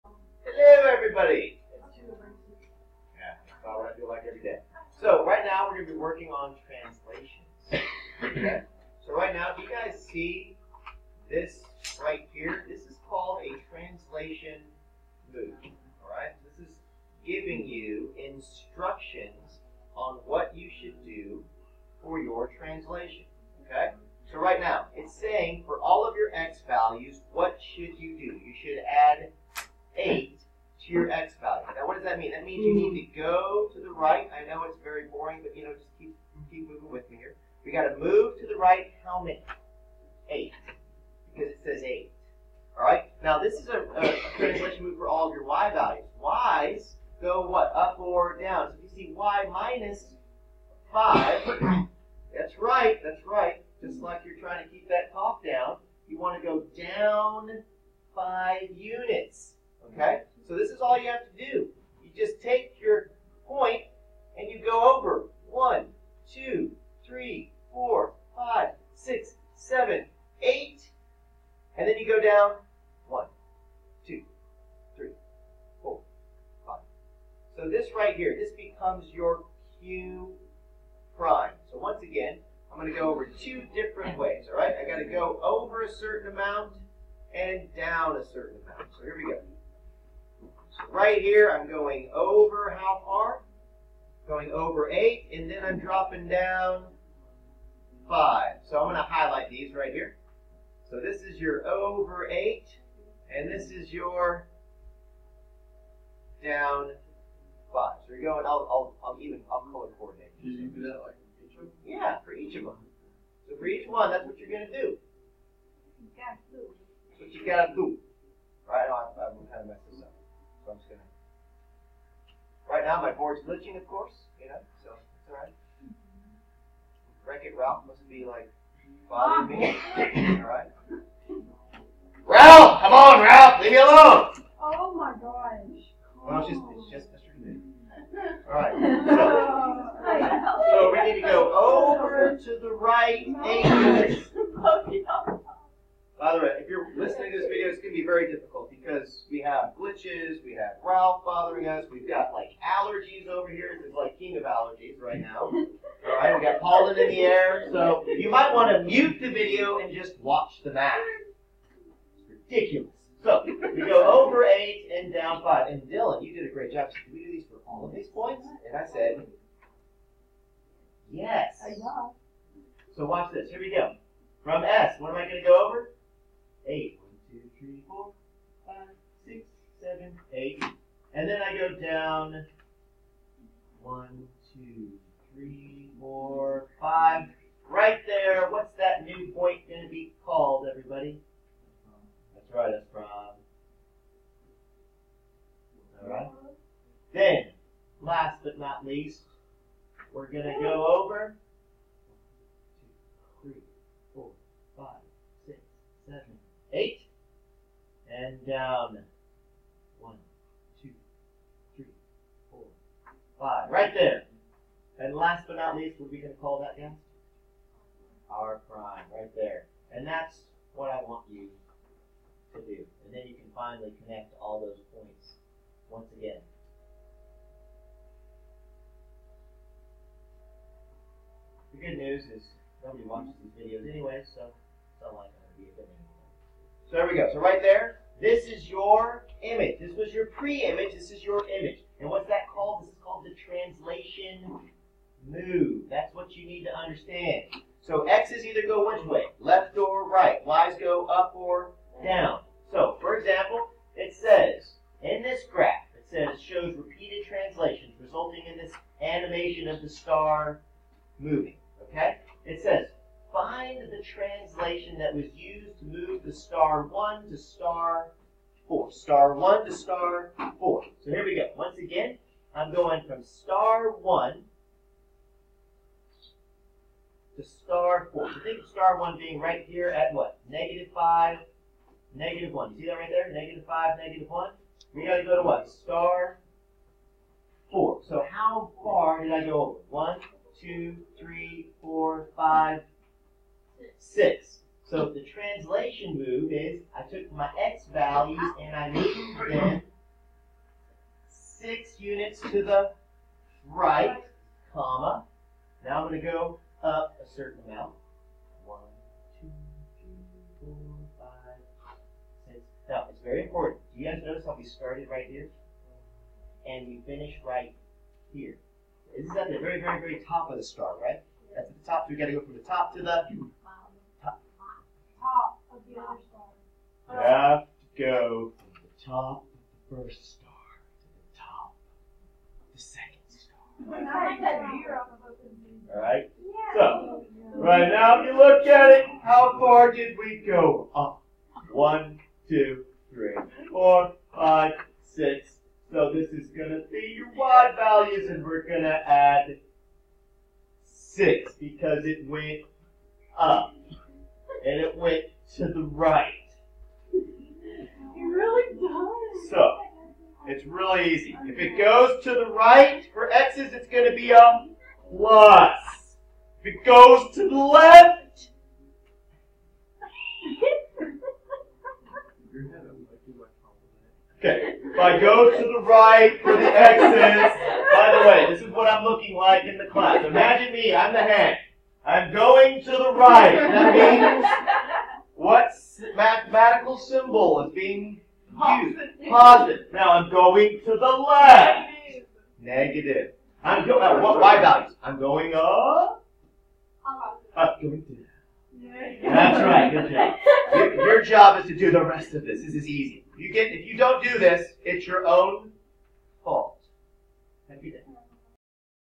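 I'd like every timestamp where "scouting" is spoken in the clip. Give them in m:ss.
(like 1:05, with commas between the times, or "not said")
not said.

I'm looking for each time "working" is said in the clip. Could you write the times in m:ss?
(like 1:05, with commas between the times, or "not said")
0:05.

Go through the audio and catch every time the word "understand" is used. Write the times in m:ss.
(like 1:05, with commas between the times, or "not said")
4:06.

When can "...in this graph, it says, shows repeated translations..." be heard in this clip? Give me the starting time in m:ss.
4:15.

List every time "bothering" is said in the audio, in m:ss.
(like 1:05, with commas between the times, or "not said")
2:09, 2:31.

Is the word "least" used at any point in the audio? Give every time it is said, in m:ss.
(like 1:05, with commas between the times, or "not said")
3:18, 3:35.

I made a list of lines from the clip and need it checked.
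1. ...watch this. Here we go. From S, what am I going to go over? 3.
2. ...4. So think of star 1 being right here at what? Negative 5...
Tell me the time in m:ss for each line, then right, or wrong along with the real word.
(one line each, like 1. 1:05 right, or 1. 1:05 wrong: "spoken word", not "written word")
1. 2:53 wrong: "8", not "3"
2. 4:38 right.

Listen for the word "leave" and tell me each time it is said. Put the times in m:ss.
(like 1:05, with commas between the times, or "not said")
2:13.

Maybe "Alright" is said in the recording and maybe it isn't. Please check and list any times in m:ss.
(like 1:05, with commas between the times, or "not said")
0:16, 5:35.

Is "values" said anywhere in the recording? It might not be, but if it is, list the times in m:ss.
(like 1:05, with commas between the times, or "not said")
0:26, 0:31, 0:45, 4:57, 5:47, 6:34.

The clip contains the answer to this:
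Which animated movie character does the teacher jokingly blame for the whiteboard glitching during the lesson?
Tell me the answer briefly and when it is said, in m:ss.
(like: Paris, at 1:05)
Wreck It Ralph, at 2:07.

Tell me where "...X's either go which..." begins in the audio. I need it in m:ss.
4:08.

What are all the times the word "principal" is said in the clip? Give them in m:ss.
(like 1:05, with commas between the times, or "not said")
not said.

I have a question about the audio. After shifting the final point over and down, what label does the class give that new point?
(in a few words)
R prime.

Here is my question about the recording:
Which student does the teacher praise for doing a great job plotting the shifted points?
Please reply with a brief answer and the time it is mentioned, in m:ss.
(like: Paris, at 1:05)
Dylan, at 2:45.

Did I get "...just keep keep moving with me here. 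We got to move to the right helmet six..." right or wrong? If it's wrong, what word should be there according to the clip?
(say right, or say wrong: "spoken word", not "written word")
wrong: "eight", not "six".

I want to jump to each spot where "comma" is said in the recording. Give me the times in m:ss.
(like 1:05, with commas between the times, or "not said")
5:04.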